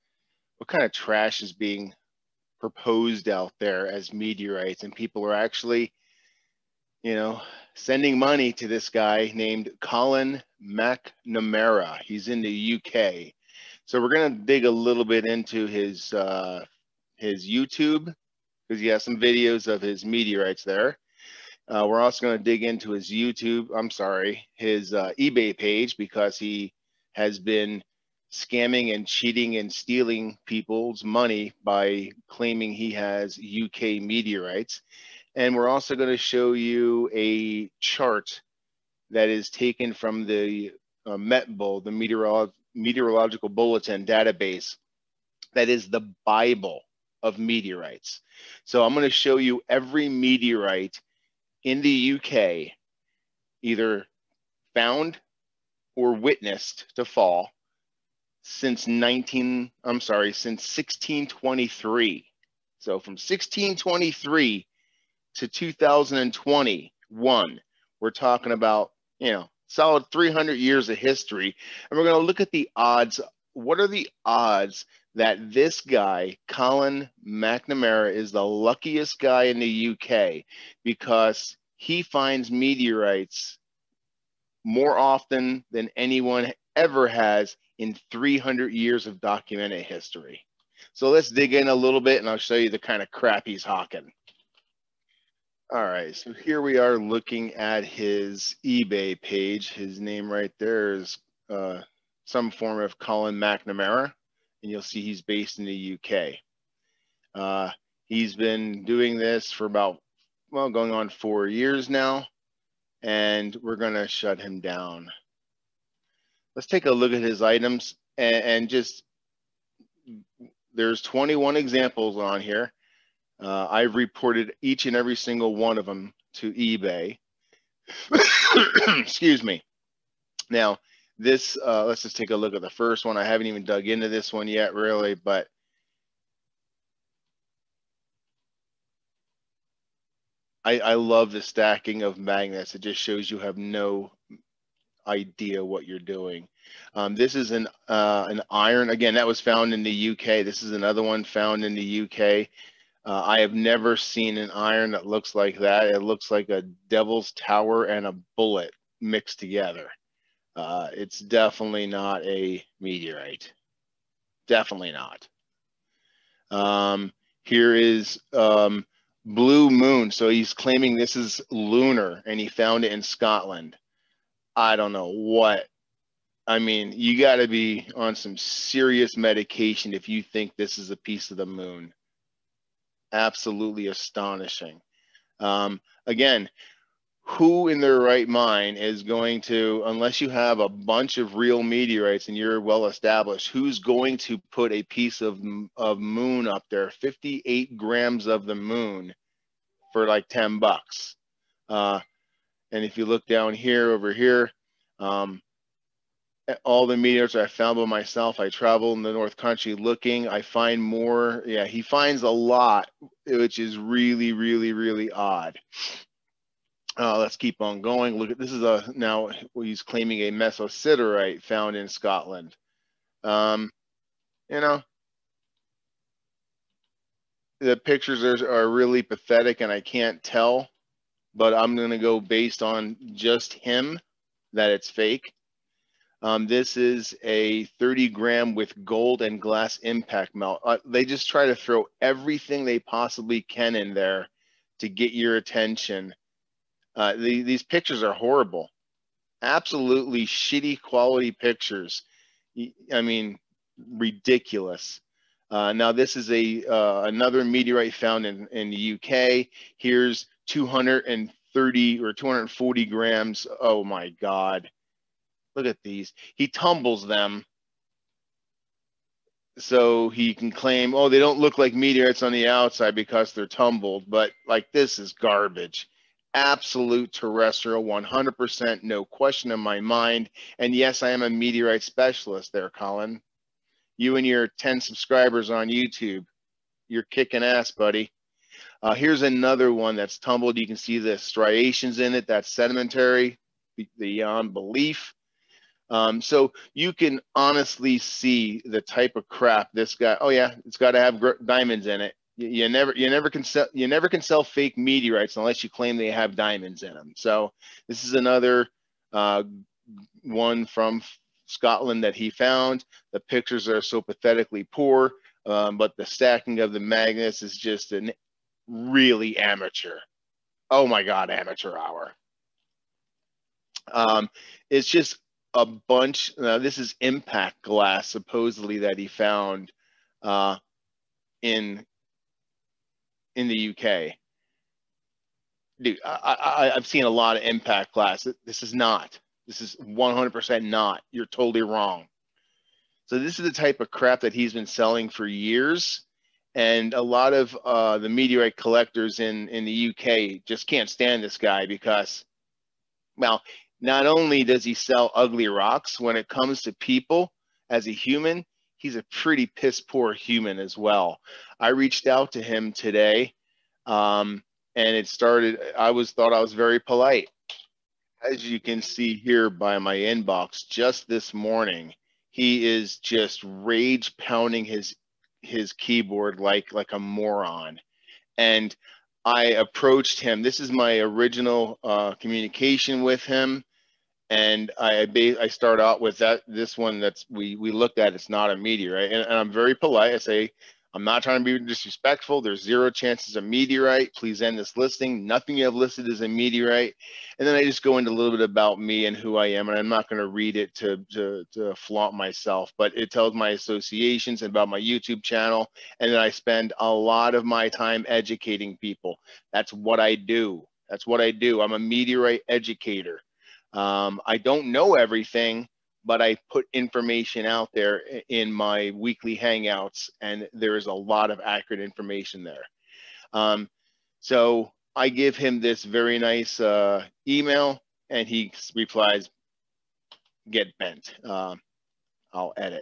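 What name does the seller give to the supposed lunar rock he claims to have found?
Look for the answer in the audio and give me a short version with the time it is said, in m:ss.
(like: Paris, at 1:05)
Blue Moon, at 2:49.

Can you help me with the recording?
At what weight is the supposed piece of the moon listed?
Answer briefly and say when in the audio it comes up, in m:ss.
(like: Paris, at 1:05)
58 grams, at 3:16.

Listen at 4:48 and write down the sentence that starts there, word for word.
Uh, here's another one that's tumbled.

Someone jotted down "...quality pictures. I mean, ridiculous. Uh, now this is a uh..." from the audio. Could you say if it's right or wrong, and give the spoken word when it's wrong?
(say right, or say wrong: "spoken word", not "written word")
right.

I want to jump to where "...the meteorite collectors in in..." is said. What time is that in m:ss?
5:47.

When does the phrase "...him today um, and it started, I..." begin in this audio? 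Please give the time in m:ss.
6:02.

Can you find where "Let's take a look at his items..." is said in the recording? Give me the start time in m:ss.
1:56.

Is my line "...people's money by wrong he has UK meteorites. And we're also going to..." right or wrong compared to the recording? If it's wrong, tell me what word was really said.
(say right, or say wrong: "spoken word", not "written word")
wrong: "claiming", not "wrong".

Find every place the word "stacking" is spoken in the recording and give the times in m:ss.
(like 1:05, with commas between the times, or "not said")
2:21, 5:16.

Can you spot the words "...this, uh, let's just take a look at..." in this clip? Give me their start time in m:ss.
2:11.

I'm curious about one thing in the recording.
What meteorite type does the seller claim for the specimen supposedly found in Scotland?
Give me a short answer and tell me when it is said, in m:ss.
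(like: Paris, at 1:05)
mesosiderite, at 3:40.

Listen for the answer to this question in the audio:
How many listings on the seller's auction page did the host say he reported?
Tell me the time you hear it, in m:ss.
2:01.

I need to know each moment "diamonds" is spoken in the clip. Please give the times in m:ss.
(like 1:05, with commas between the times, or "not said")
5:01, 5:06.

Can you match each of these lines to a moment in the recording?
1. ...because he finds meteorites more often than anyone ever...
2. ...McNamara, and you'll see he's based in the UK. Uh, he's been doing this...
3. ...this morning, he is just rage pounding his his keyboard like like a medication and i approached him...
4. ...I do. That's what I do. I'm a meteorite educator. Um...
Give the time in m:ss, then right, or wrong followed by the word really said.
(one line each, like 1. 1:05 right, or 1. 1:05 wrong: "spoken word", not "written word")
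1. 1:20 right
2. 1:43 right
3. 6:11 wrong: "moron", not "medication"
4. 6:50 right.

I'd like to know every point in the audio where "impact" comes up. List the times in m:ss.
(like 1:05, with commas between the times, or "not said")
3:59, 5:27, 5:37.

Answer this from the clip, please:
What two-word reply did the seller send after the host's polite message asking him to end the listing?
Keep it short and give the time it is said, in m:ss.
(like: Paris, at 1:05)
Get bent, at 7:10.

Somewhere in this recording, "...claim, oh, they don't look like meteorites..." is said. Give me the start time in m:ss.
4:30.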